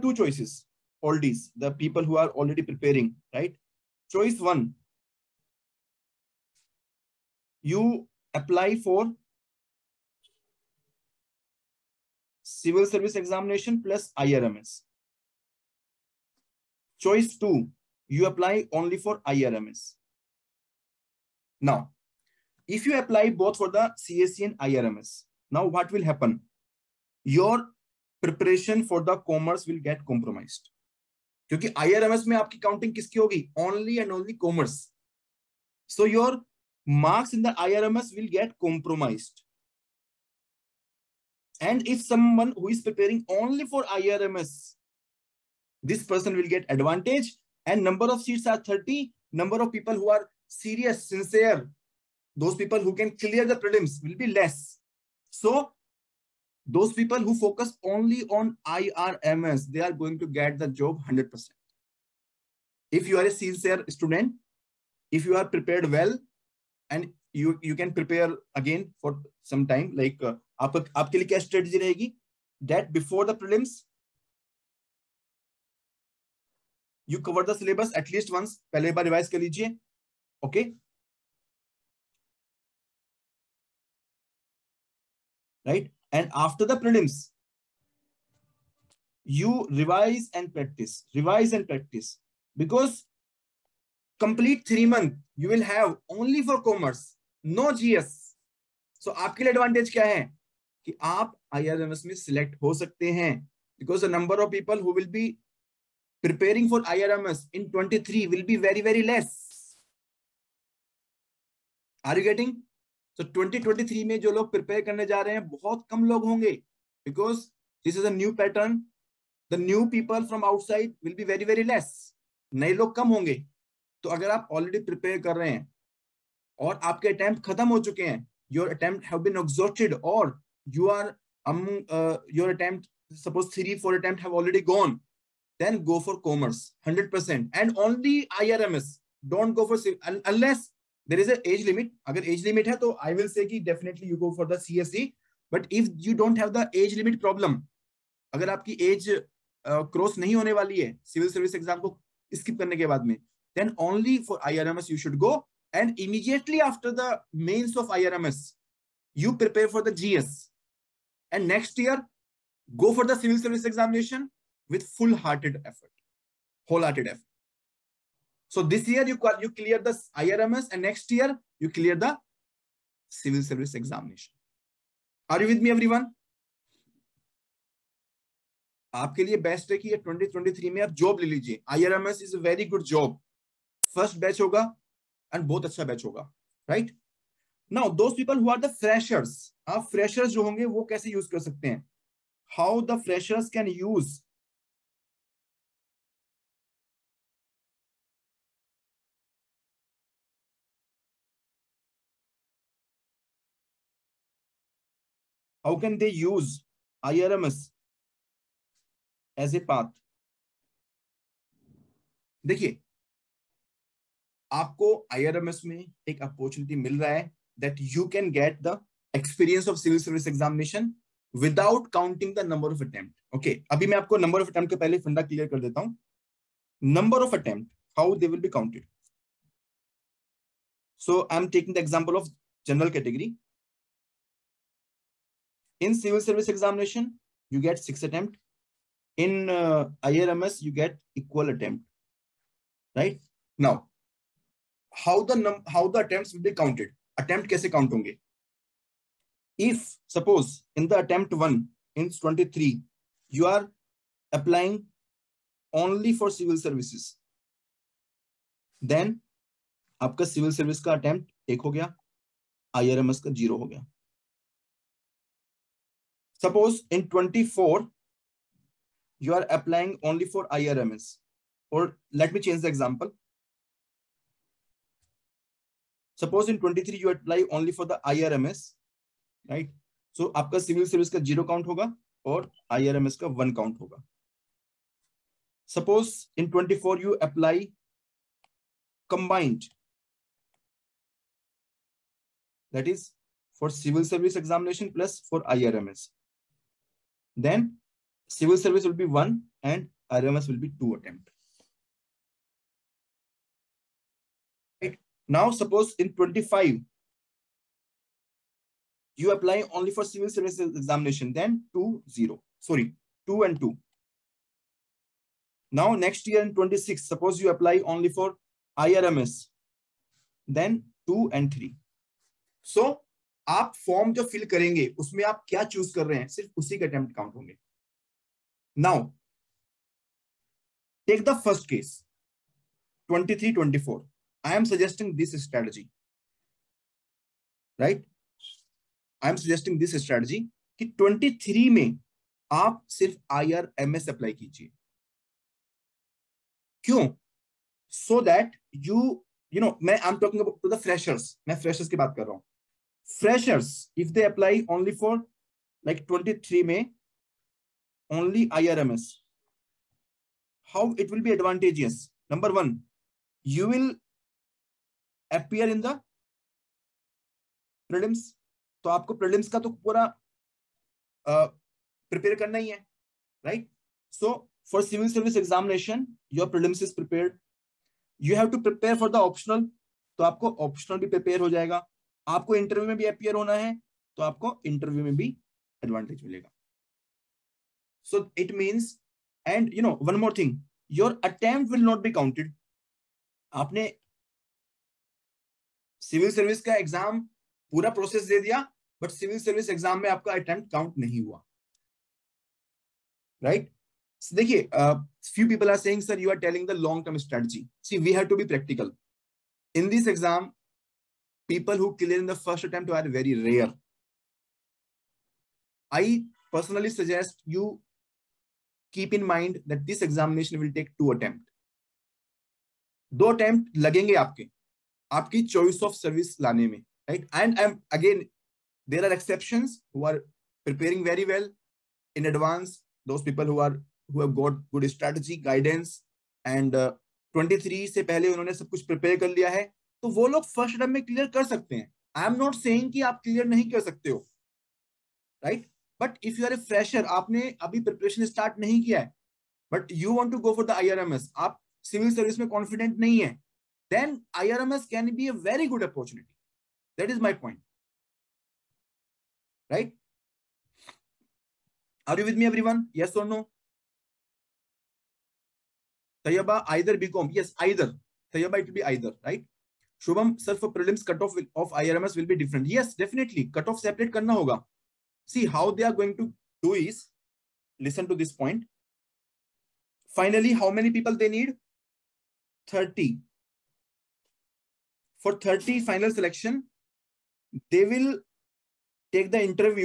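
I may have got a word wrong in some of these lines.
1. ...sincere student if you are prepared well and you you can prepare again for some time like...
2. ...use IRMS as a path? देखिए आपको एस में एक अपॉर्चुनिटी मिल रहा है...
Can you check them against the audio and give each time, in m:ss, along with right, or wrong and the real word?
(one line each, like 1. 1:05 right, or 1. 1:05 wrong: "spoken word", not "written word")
1. 1:03 right
2. 3:26 right.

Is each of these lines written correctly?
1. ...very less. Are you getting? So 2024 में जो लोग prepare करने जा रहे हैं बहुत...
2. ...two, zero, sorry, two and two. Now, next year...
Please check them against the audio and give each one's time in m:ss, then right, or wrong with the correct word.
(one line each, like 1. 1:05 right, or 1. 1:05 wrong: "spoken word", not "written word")
1. 1:48 wrong: "2023", not "2024"
2. 5:11 right.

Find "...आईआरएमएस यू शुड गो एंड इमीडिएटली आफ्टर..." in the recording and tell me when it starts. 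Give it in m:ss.
2:34.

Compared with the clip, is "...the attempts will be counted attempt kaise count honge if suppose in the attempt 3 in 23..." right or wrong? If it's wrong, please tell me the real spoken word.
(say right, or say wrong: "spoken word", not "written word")
wrong: "1", not "3".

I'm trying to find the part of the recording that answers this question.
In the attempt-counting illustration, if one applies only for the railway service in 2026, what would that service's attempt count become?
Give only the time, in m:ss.
5:21.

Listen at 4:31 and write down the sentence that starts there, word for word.
Or let me change the example.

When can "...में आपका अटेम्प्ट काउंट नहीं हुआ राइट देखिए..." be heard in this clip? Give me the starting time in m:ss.
6:40.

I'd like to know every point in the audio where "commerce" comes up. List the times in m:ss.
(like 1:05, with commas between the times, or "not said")
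0:29, 0:34, 2:16.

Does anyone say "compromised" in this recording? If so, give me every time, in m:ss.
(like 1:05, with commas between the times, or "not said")
0:30, 0:38.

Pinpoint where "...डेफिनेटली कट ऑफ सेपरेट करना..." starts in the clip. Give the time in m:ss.
7:52.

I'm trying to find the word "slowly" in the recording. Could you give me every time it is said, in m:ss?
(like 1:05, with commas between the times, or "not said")
not said.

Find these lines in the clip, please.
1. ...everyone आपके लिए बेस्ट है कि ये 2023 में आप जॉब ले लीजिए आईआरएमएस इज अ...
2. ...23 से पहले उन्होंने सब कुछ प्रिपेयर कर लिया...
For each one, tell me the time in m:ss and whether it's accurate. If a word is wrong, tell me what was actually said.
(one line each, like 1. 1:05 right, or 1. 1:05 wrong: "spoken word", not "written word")
1. 2:55 right
2. 7:17 right.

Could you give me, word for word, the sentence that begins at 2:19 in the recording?
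Don't go for unless there is a age limit.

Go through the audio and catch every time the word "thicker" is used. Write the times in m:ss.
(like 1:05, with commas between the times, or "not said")
not said.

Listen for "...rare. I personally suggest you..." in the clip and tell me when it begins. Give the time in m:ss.
6:53.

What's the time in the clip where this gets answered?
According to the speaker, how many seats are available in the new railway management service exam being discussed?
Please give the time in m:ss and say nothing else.
0:47.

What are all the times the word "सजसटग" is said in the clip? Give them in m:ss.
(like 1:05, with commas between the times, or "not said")
5:34, 5:39.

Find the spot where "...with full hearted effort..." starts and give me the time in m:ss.
2:44.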